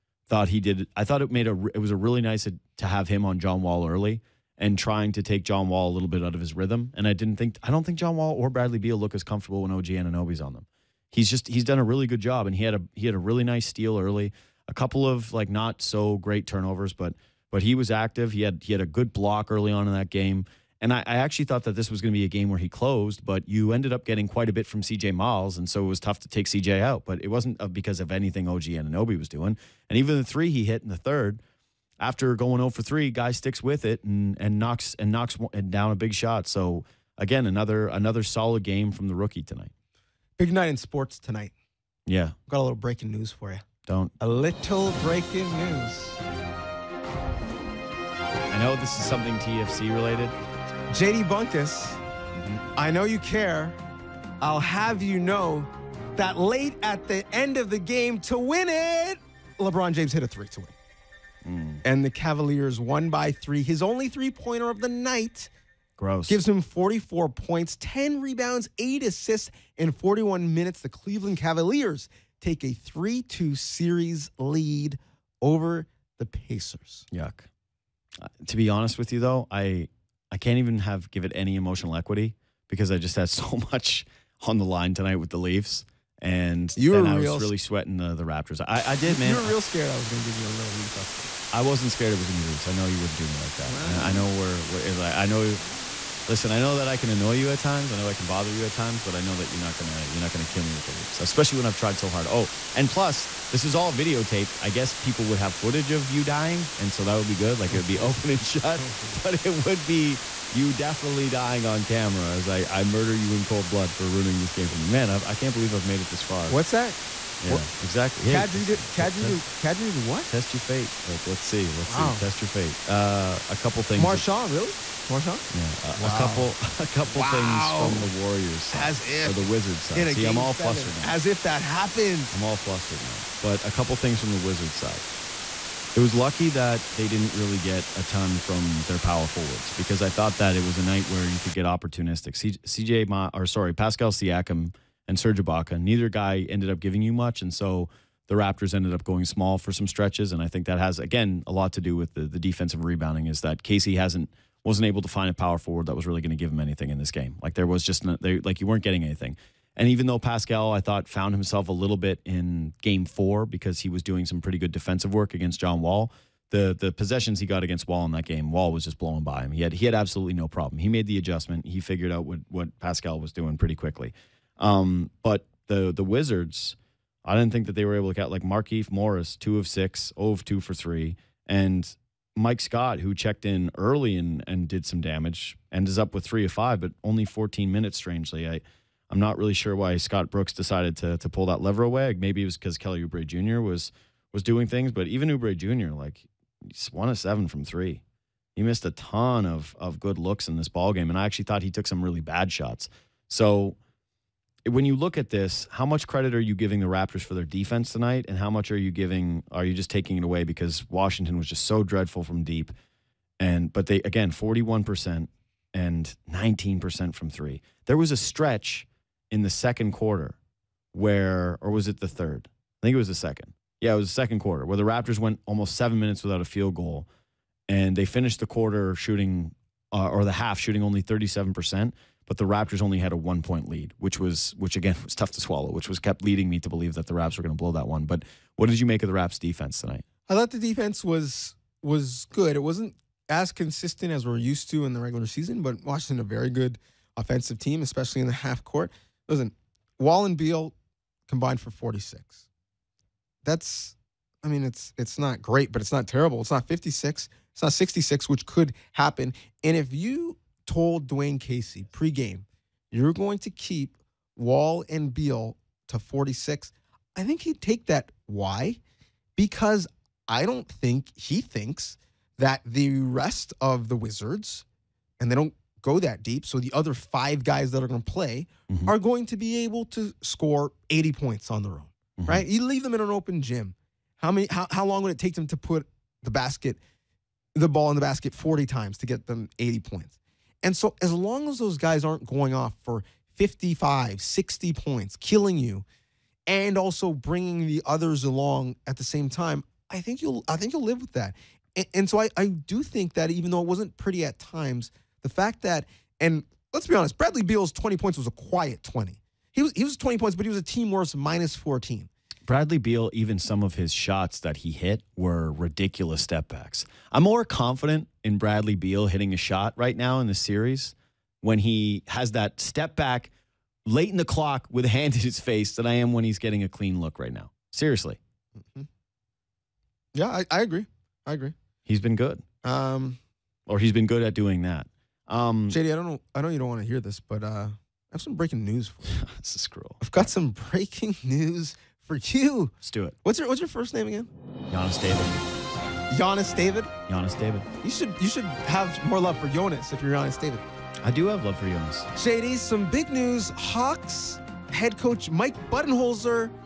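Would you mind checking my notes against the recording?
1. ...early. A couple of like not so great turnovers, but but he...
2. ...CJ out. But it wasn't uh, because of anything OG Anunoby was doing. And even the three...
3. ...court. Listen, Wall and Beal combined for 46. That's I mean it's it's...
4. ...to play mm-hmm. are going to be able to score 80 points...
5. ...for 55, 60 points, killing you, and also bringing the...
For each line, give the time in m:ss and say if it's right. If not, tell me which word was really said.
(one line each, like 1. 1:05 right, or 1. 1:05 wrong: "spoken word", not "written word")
1. 0:13 right
2. 0:26 right
3. 4:08 right
4. 4:38 right
5. 4:52 right.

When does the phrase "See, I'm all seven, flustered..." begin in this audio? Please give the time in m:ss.
2:10.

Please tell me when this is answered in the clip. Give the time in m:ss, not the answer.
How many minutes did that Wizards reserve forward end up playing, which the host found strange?
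3:07.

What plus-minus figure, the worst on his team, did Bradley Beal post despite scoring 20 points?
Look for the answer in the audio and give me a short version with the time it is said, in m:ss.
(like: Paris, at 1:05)
-14, at 5:11.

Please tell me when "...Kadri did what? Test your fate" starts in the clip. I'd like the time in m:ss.
1:59.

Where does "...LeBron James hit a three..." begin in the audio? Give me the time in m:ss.
0:59.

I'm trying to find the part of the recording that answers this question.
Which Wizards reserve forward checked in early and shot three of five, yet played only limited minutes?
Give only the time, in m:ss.
3:02.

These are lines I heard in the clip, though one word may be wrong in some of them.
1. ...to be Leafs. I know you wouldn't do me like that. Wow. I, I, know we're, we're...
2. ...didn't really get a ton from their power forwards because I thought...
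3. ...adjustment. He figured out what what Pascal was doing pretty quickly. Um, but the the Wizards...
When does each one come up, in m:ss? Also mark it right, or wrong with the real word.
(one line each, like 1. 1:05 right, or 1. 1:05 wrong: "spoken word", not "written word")
1. 1:32 right
2. 2:17 right
3. 2:51 right.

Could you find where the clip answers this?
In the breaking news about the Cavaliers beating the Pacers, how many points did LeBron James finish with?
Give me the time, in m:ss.
1:06.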